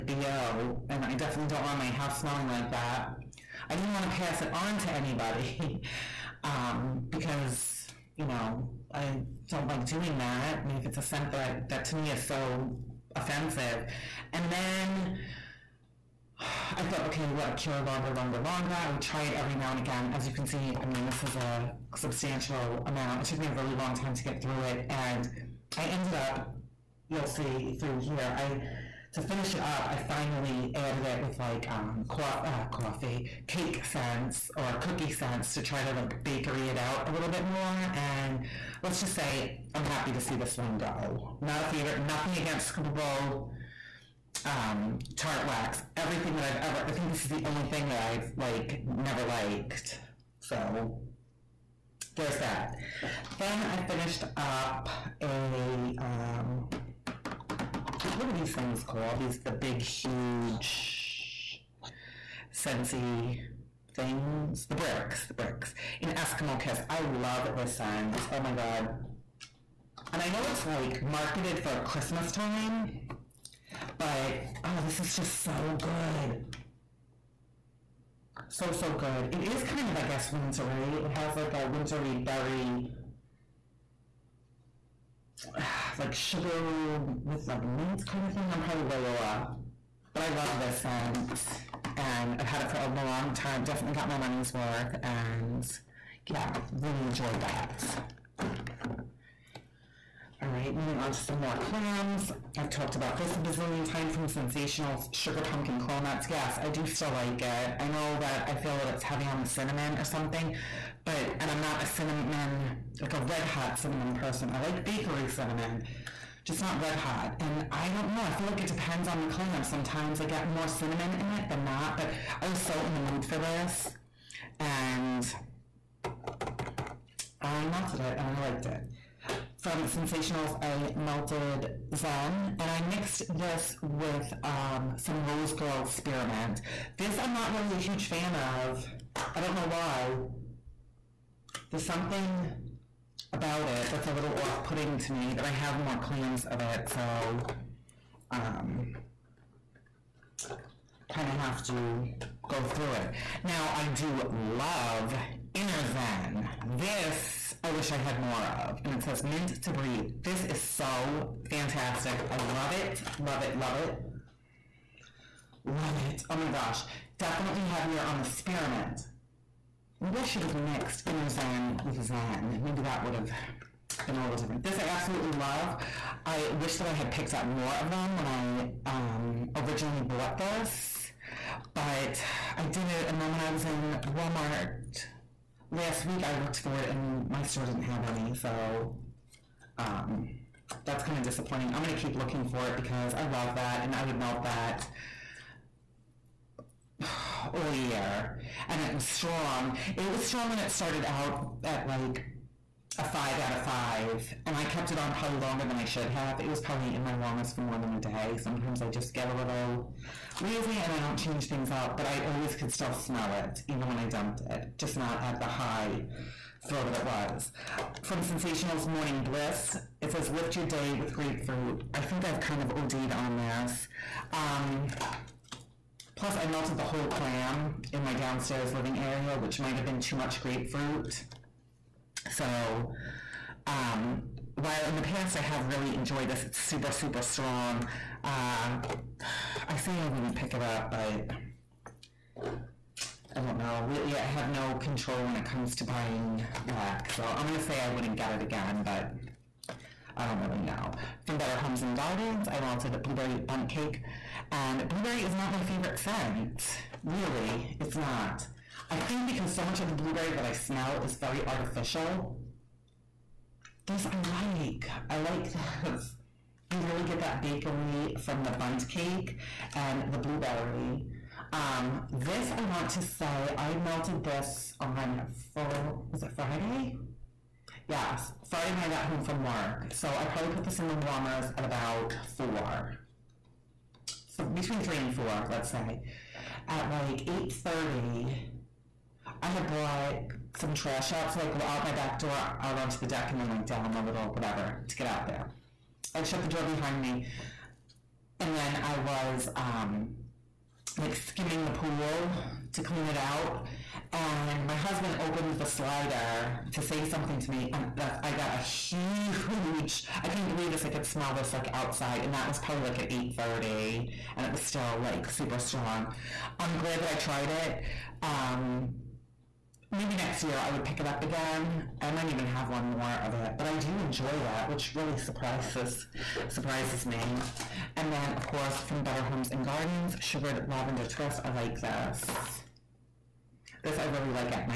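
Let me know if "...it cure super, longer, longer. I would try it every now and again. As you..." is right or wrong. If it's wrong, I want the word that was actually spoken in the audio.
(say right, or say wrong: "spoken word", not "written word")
wrong: "longer", not "super".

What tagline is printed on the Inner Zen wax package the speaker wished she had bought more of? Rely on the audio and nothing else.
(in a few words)
Mint to Breathe.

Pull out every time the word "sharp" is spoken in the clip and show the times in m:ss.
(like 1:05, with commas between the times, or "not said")
not said.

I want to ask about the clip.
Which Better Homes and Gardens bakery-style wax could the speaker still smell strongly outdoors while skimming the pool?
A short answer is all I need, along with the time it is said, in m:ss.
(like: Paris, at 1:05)
Blueberry bundt cake, at 4:13.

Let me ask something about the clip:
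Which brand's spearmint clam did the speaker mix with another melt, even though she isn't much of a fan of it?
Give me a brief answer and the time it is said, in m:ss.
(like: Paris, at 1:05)
Rose Girl, at 2:15.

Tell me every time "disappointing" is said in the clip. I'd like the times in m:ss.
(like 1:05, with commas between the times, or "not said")
3:11.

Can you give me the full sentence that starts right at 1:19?
It is kind of, I guess, wintry.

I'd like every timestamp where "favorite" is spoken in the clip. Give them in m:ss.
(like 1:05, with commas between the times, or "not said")
0:41, 4:15.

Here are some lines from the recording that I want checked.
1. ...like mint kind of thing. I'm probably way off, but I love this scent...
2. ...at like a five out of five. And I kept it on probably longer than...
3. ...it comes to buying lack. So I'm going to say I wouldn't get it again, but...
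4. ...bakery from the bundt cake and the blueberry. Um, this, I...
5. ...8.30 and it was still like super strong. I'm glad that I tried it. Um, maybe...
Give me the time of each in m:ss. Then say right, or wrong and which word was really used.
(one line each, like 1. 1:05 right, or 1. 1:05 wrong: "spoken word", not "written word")
1. 1:27 right
2. 3:21 right
3. 4:05 right
4. 4:27 right
5. 5:13 right.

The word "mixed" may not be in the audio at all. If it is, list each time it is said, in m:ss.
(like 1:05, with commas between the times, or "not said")
2:12, 2:50.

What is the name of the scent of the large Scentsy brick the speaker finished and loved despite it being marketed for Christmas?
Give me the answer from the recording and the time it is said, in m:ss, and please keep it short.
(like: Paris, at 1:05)
Eskimo Kiss, at 1:06.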